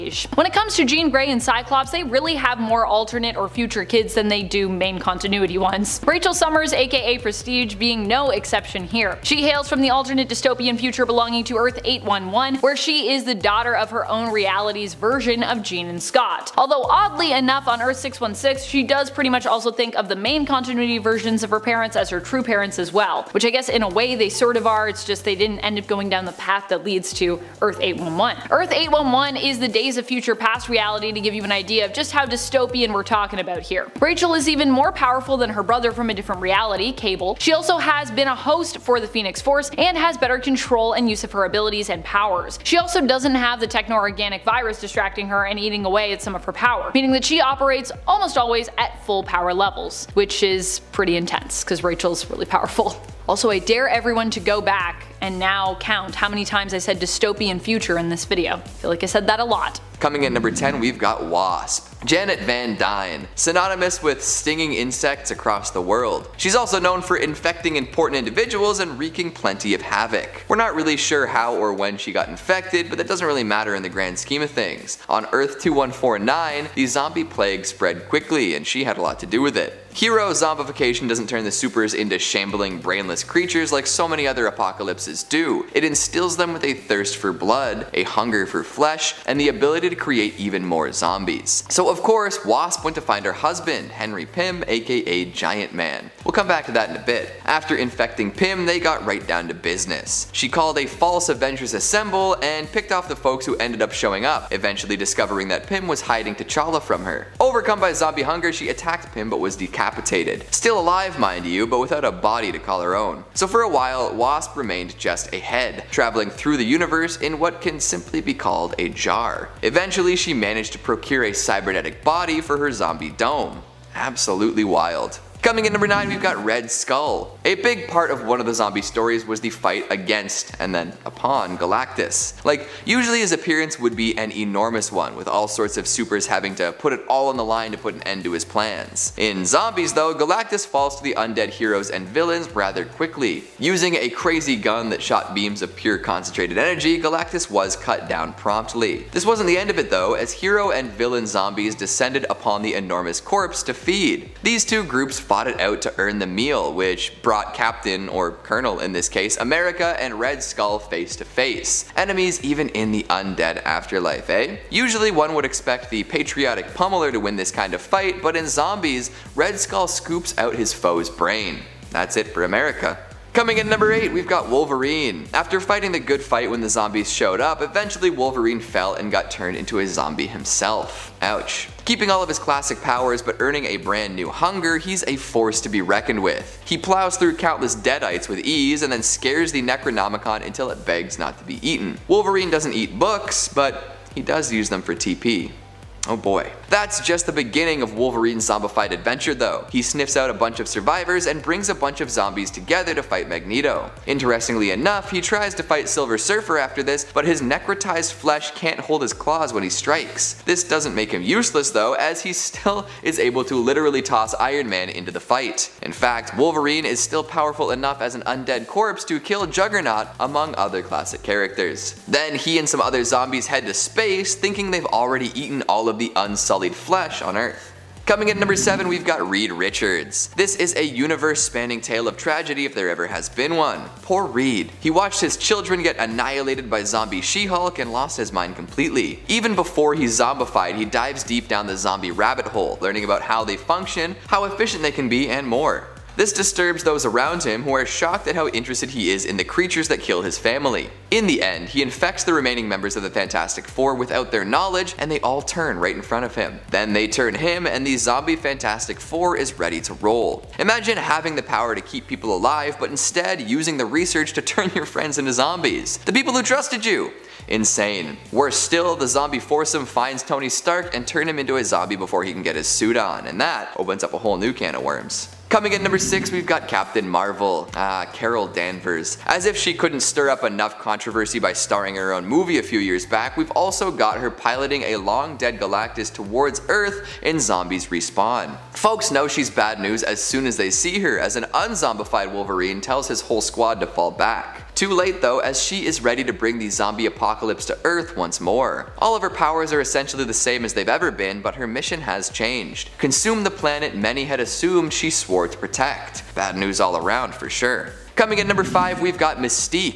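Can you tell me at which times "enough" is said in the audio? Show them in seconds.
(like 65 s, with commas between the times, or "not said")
17 s, 204 s, 217 s, 280 s.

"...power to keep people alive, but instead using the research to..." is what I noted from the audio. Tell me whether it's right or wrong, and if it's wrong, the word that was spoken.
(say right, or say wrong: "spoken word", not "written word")
right.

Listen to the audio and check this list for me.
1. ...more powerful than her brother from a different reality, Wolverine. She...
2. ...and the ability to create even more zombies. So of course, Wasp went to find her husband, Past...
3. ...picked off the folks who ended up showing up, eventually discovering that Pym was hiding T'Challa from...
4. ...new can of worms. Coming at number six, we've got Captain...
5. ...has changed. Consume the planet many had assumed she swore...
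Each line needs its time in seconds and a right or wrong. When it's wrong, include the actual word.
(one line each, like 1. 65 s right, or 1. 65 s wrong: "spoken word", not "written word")
1. 34 s wrong: "Cable", not "Wolverine"
2. 89 s wrong: "Henry", not "Past"
3. 102 s right
4. 274 s right
5. 301 s right.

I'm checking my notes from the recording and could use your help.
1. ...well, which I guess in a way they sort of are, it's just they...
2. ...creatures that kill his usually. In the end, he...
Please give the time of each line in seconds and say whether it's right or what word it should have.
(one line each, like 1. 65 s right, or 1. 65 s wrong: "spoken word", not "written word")
1. 22 s right
2. 249 s wrong: "family", not "usually".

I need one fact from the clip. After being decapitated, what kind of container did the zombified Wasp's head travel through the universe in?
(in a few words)
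a jar.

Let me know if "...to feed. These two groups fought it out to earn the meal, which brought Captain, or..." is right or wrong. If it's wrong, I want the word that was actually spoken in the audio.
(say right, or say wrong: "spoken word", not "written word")
right.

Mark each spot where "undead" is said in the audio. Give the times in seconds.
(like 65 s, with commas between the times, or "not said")
141 s, 163 s, 218 s.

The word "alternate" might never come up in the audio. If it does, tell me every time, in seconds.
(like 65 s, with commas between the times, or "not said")
2 s, 9 s.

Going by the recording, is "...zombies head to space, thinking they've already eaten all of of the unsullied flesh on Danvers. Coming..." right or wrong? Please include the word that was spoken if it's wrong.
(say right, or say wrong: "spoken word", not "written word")
wrong: "Earth", not "Danvers".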